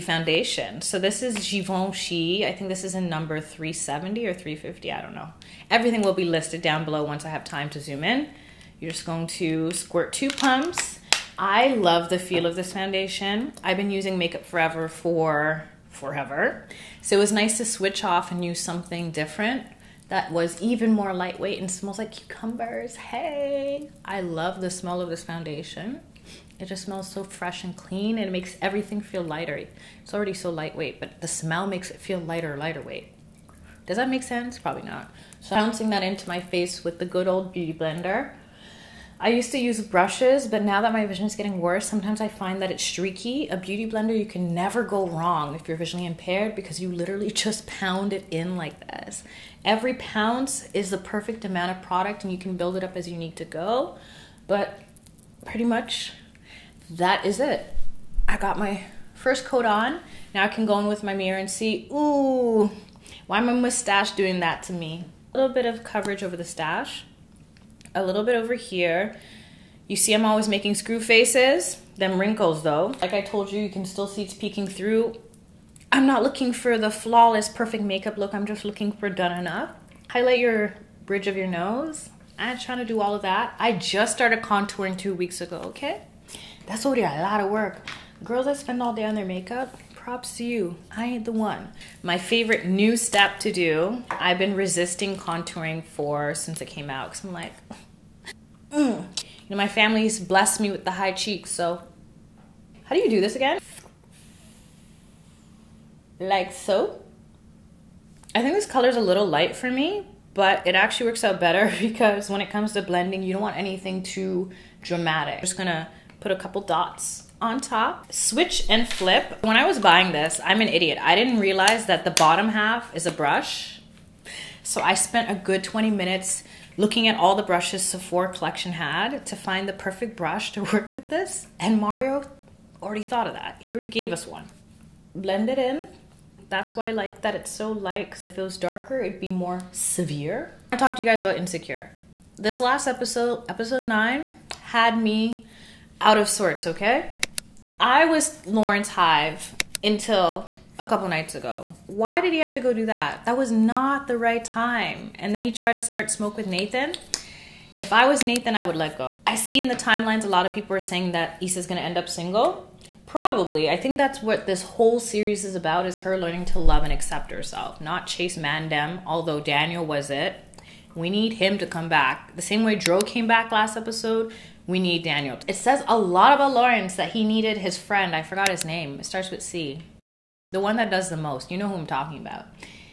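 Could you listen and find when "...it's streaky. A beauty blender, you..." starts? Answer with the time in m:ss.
0:42.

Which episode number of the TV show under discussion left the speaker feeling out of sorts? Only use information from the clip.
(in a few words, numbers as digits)
9.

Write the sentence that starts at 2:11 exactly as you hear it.
And Mario already thought of that.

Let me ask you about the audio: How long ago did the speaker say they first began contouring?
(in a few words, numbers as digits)
Two weeks ago.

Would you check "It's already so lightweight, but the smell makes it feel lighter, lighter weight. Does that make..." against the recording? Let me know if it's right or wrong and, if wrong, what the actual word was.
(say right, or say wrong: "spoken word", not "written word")
right.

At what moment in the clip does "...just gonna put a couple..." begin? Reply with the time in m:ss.
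1:55.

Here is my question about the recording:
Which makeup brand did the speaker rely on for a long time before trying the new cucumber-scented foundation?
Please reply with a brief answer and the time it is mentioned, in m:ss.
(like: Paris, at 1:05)
Makeup Forever, at 0:14.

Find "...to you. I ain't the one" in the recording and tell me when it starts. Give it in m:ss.
1:30.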